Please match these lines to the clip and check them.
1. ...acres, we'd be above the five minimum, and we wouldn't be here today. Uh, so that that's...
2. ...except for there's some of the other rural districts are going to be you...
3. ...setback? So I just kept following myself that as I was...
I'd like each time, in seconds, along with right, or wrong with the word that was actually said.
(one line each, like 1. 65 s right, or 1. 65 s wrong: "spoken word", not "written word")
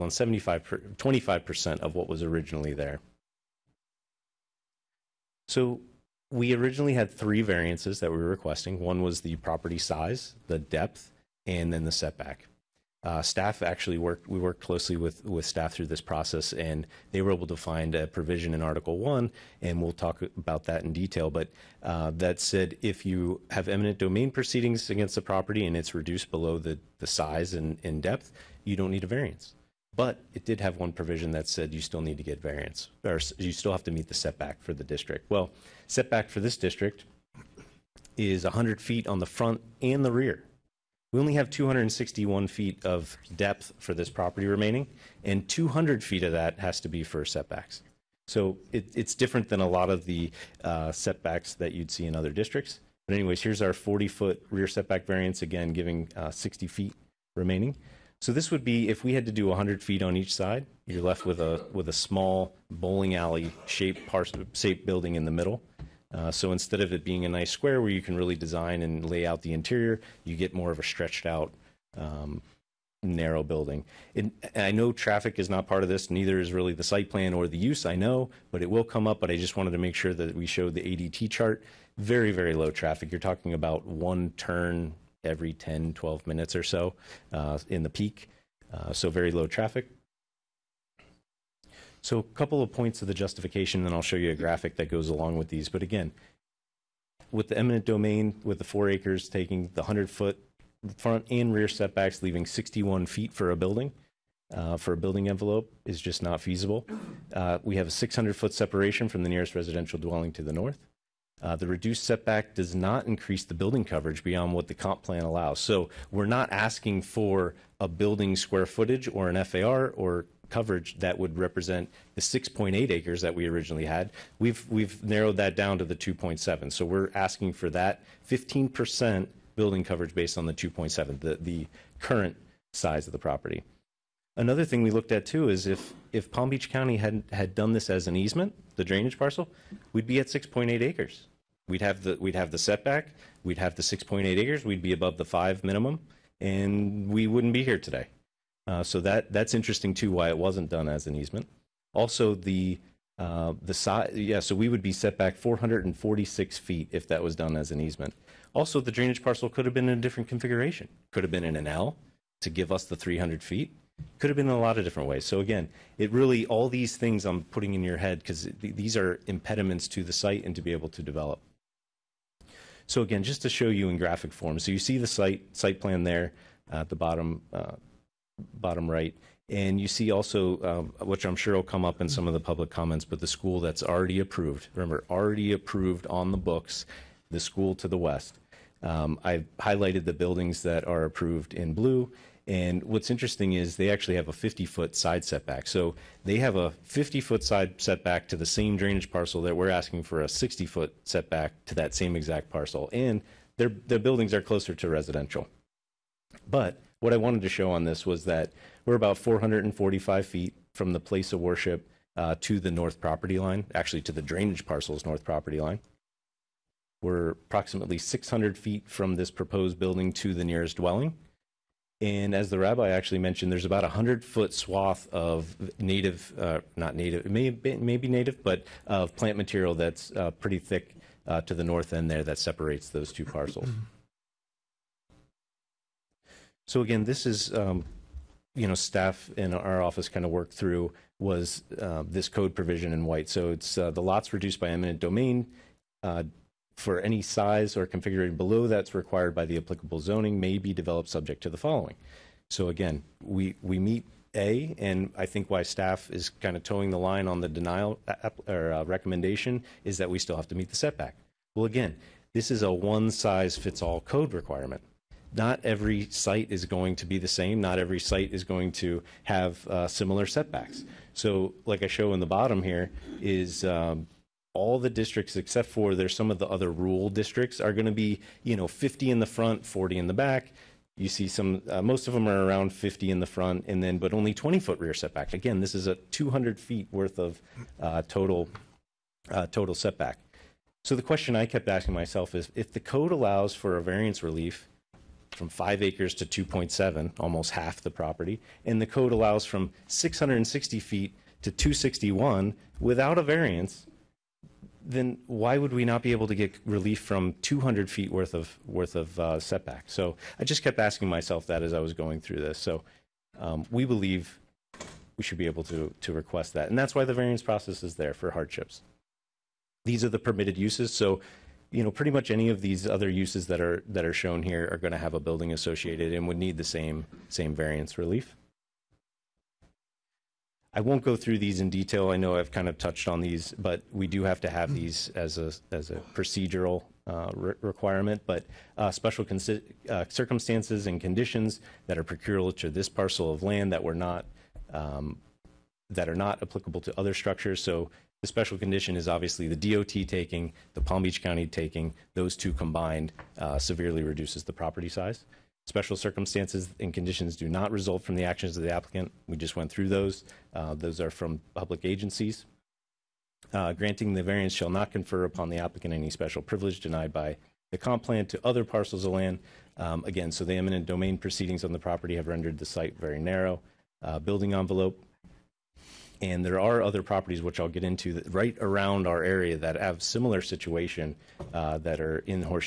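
1. 144 s right
2. 275 s right
3. 309 s wrong: "asking", not "following".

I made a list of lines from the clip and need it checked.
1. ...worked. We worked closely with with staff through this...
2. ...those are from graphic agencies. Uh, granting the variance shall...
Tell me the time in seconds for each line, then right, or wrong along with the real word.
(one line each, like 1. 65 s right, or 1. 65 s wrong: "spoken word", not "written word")
1. 13 s right
2. 360 s wrong: "public", not "graphic".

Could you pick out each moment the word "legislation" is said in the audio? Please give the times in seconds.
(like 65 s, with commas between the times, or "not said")
not said.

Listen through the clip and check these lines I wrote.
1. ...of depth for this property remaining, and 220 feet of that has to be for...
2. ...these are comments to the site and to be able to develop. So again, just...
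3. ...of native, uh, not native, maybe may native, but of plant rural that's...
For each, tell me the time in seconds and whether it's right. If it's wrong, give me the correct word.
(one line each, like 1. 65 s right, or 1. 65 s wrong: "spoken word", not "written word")
1. 42 s wrong: "200", not "220"
2. 168 s wrong: "impediments", not "comments"
3. 225 s wrong: "material", not "rural".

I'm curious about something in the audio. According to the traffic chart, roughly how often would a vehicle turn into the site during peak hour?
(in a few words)
every 10 to 12 minutes.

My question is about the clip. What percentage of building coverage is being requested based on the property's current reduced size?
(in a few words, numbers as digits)
15%.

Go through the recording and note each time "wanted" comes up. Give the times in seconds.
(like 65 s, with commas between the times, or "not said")
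79 s, 207 s.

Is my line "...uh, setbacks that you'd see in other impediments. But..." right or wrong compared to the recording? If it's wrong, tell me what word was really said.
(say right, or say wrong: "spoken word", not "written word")
wrong: "districts", not "impediments".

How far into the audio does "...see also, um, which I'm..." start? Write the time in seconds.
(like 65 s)
179 s.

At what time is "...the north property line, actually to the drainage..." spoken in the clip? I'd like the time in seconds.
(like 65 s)
212 s.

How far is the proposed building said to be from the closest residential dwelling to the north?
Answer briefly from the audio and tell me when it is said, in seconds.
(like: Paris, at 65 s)
600 feet, at 107 s.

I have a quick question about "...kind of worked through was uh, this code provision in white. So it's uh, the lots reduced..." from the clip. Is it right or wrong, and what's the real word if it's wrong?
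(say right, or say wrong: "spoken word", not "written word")
right.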